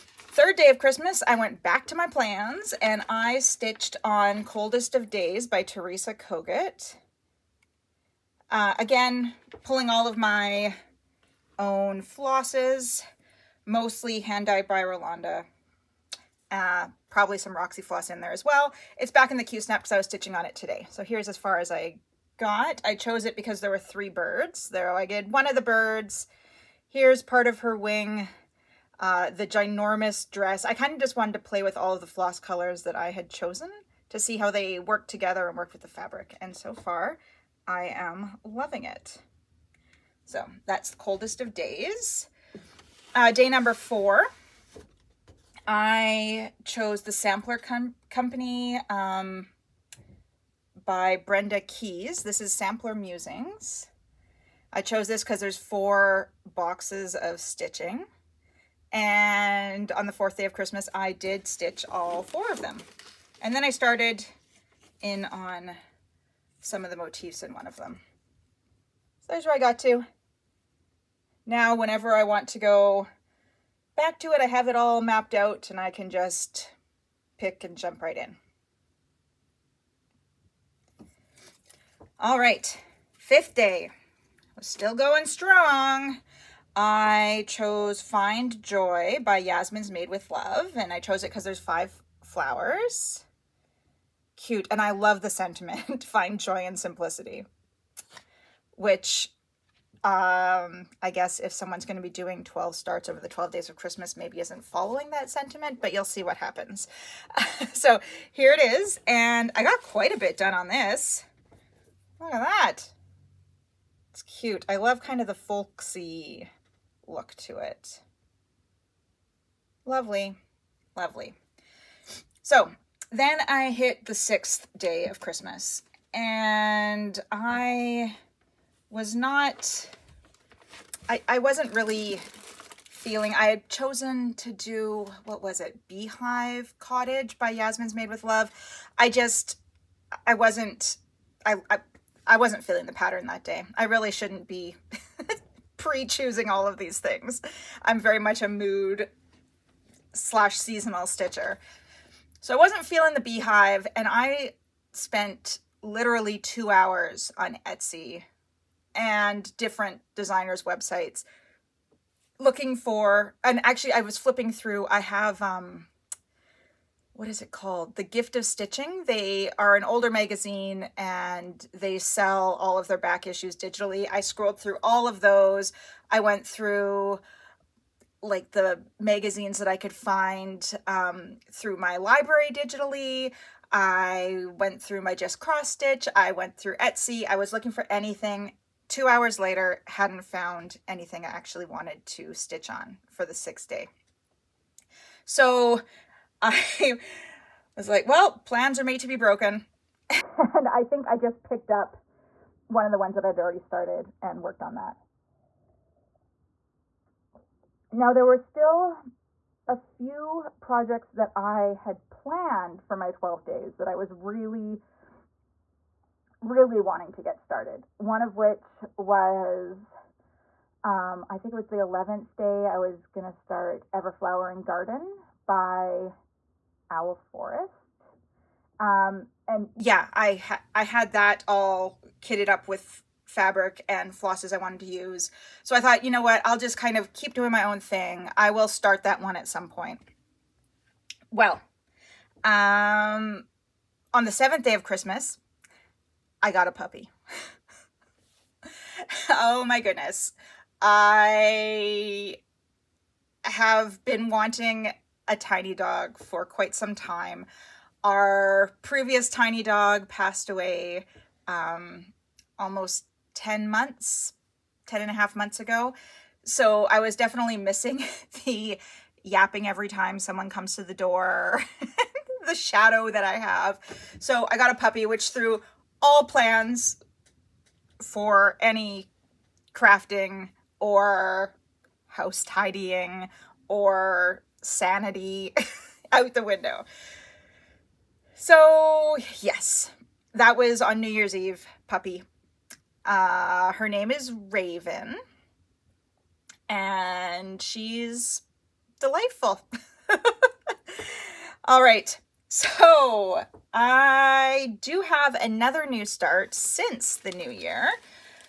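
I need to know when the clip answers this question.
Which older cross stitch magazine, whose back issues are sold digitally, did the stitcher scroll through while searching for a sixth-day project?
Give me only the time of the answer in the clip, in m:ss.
2:47.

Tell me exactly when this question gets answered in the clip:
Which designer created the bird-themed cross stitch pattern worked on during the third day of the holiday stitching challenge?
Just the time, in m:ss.
0:05.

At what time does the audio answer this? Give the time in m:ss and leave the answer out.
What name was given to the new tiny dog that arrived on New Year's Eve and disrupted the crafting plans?
4:54.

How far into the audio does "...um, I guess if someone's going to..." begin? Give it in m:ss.
1:40.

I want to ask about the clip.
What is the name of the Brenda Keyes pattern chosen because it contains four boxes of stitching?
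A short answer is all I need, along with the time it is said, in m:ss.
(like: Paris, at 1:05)
Sampler Musings, at 0:52.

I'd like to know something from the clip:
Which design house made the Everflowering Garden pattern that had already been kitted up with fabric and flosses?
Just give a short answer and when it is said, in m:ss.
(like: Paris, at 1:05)
Owl Forest, at 3:46.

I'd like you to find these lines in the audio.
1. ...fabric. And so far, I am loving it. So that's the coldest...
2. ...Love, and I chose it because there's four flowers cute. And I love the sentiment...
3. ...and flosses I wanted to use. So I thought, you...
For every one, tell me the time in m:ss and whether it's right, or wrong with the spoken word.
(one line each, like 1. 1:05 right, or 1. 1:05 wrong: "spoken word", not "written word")
1. 0:35 right
2. 1:30 wrong: "five", not "four"
3. 3:53 right.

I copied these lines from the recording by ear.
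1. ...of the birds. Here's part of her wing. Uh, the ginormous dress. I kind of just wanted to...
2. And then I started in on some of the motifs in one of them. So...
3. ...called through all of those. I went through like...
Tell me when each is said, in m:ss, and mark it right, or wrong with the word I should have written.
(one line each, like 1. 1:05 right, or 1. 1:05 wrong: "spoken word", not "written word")
1. 0:25 right
2. 1:03 right
3. 2:54 wrong: "scrolled", not "called".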